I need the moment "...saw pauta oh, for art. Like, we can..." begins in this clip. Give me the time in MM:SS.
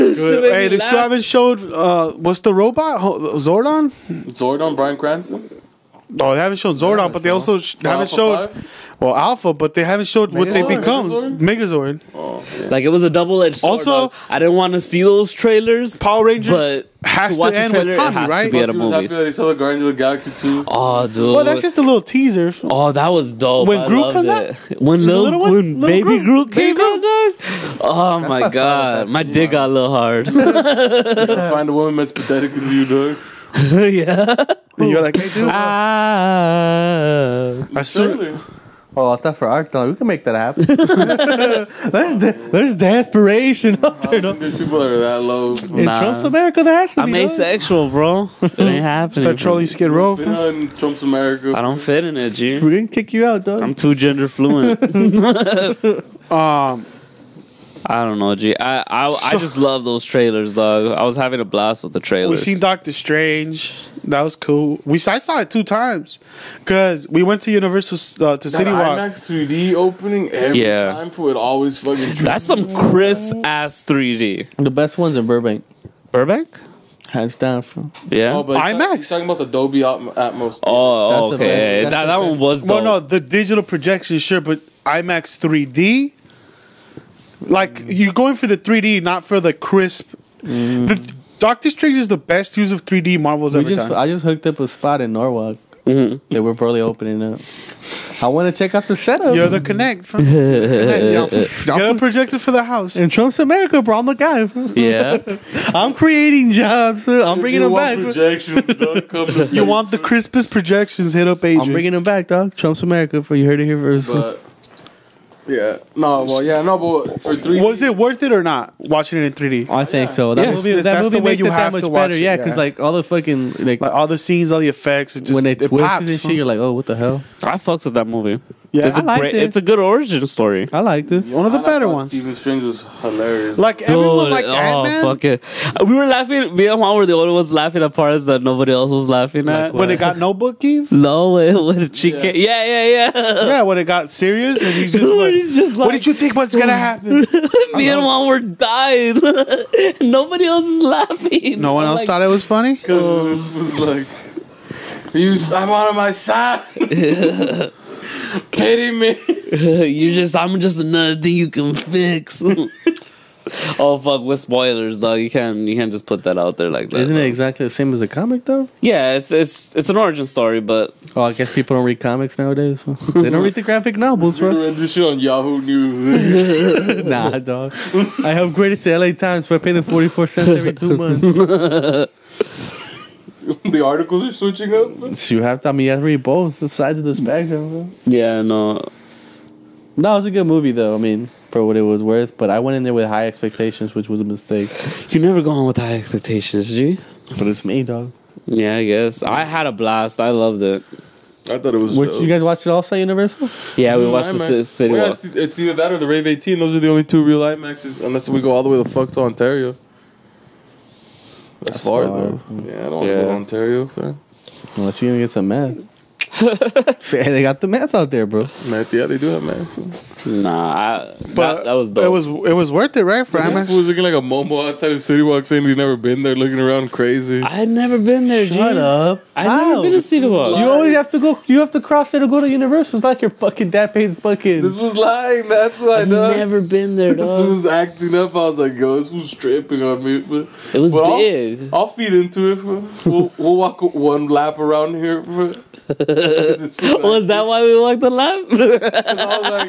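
00:37.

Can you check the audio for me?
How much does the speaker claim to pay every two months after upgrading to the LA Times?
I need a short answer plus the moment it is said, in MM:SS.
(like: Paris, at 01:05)
44 cents, at 02:59.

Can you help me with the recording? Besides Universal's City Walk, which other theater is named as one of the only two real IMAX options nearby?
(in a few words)
Rave 18.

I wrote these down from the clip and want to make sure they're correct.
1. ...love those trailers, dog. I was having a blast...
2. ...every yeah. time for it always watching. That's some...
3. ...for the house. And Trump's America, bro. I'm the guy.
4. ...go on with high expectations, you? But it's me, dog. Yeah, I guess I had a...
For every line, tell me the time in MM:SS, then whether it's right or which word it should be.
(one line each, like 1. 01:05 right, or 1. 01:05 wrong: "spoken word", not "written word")
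1. 00:59 right
2. 01:10 wrong: "fucking", not "watching"
3. 01:42 right
4. 03:15 right.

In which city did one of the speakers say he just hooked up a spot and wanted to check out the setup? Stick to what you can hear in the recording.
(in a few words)
Norwalk.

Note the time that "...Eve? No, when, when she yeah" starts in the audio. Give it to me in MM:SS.
02:20.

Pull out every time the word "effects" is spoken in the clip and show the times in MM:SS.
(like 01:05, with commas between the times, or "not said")
02:04.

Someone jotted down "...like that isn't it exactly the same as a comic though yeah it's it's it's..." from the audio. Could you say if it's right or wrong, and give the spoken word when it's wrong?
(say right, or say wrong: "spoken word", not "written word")
right.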